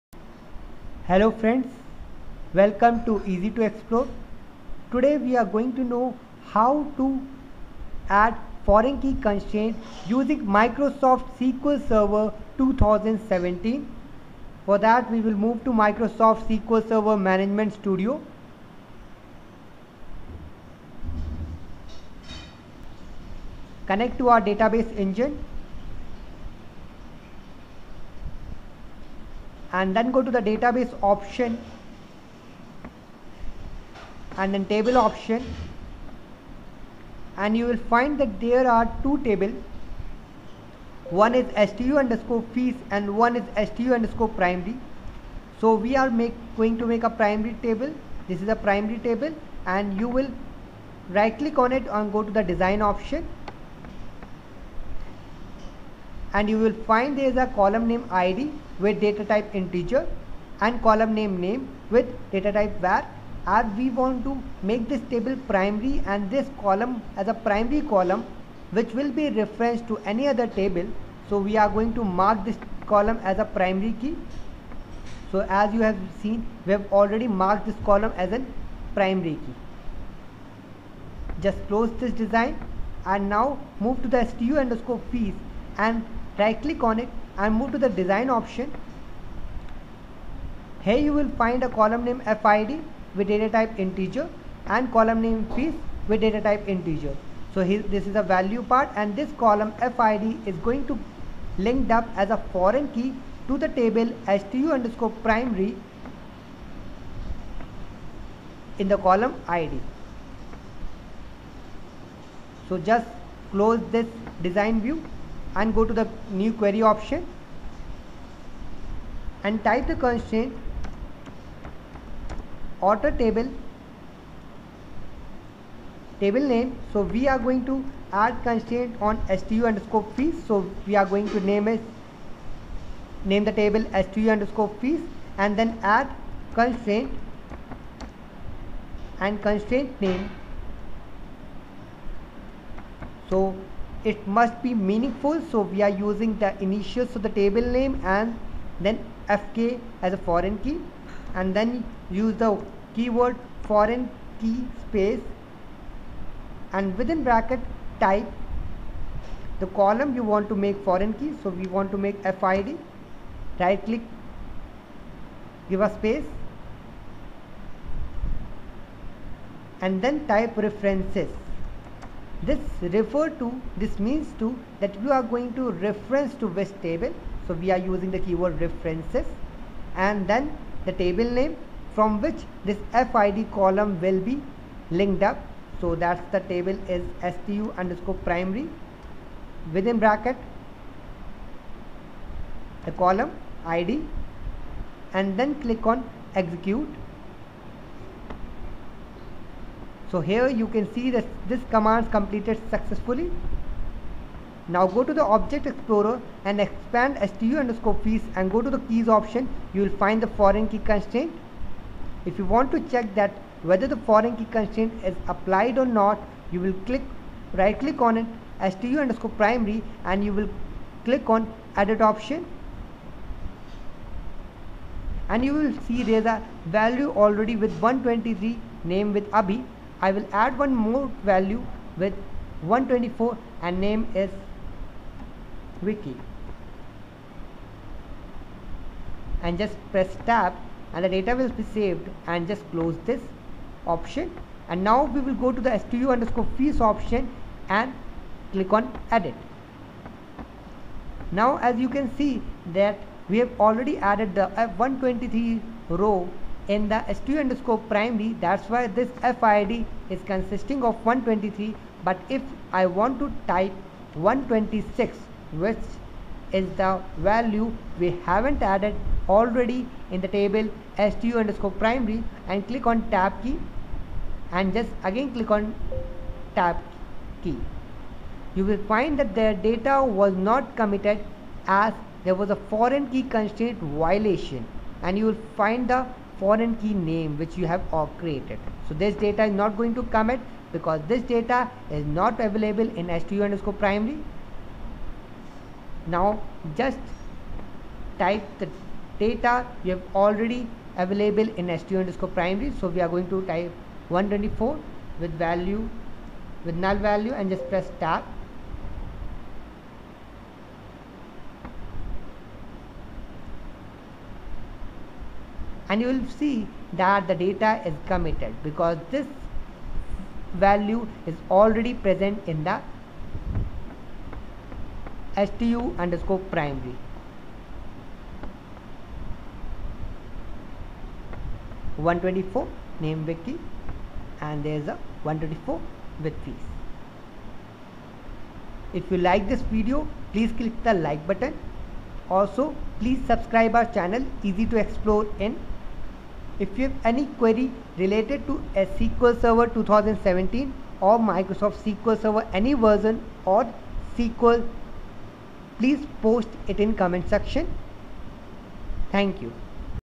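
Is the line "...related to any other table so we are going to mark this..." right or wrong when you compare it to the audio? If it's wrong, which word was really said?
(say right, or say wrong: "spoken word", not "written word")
wrong: "referenced", not "related".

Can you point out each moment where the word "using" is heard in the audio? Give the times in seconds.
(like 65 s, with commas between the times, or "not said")
10 s, 146 s, 177 s.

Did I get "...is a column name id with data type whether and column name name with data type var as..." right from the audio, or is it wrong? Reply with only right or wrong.
wrong.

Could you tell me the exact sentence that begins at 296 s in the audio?
Now just type the data you have already available in stu underscore primary.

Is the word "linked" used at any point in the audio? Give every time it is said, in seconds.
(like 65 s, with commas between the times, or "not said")
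101 s, 184 s.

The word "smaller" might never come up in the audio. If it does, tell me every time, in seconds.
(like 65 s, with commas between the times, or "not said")
not said.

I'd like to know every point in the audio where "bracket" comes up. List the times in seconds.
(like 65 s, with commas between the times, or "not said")
157 s, 189 s.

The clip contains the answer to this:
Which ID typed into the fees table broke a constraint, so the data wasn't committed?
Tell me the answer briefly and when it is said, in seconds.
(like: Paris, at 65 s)
126, at 264 s.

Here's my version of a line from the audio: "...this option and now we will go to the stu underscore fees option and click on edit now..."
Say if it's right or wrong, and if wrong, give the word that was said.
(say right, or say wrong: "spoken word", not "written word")
right.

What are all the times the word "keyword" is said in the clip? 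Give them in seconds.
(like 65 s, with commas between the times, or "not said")
152 s, 178 s.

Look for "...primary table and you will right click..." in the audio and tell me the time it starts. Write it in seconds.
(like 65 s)
48 s.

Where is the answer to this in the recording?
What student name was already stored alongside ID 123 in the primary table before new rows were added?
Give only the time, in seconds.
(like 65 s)
229 s.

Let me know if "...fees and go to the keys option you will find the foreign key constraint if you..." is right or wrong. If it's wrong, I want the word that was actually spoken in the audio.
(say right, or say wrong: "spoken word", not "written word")
right.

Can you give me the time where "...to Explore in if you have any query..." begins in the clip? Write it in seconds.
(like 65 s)
344 s.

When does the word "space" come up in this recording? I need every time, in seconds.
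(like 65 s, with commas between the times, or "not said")
154 s, 165 s.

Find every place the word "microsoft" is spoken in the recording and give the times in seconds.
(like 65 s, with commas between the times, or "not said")
10 s, 15 s, 351 s.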